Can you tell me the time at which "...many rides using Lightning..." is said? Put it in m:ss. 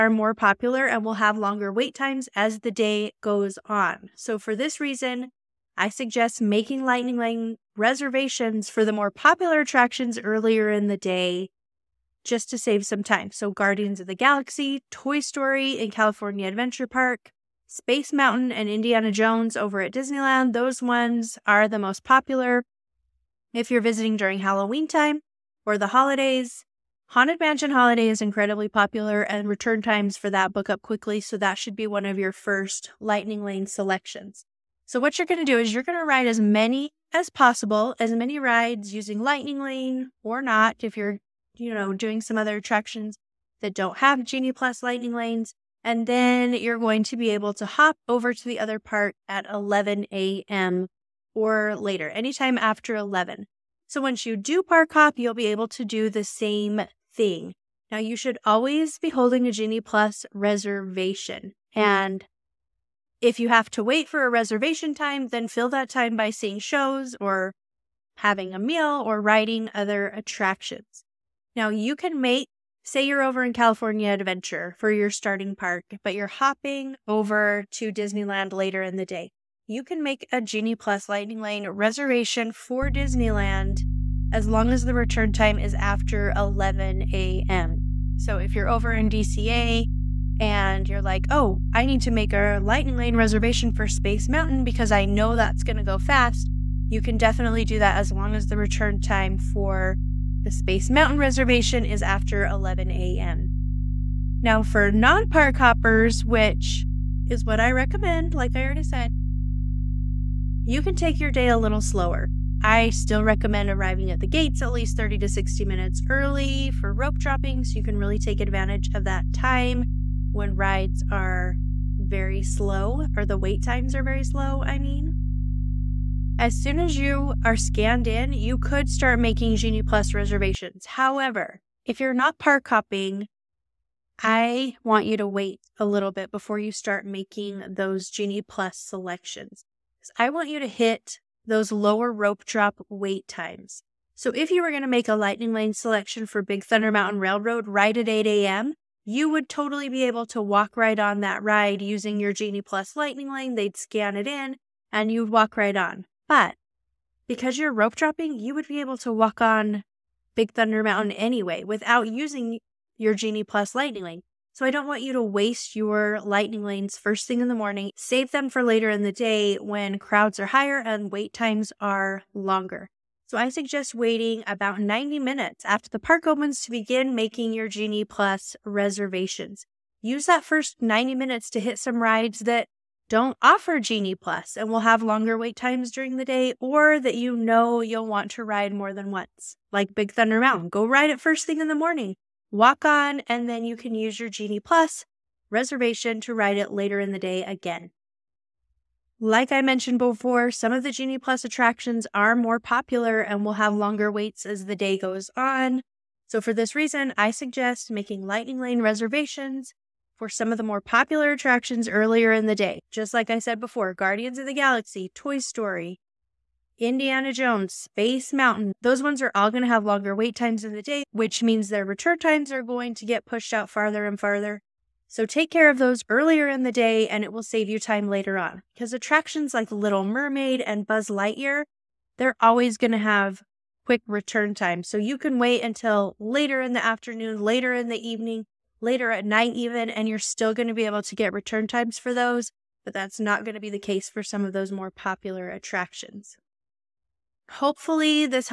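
0:38.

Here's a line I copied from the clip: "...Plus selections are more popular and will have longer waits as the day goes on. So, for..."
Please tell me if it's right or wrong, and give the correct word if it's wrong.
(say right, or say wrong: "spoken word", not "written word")
wrong: "attractions", not "selections".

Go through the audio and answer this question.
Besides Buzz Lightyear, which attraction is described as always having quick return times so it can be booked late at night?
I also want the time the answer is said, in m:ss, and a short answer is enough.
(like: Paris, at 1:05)
Little Mermaid, at 3:49.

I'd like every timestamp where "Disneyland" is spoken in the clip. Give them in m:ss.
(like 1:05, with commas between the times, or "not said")
0:19, 1:17, 1:22.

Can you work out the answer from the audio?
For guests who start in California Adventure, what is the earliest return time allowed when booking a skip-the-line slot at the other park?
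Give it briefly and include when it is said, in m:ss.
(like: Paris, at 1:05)
11 a.m., at 1:25.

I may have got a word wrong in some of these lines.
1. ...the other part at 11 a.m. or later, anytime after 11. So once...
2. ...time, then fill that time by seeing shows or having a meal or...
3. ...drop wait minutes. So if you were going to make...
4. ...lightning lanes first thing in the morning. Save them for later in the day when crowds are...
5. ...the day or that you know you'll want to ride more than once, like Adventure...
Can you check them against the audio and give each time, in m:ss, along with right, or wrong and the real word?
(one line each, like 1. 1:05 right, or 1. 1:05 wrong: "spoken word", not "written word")
1. 0:48 right
2. 1:04 right
3. 2:22 wrong: "times", not "minutes"
4. 2:46 right
5. 3:06 wrong: "Big", not "Adventure".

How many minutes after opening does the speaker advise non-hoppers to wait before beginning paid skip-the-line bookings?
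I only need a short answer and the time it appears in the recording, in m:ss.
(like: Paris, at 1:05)
90, at 2:54.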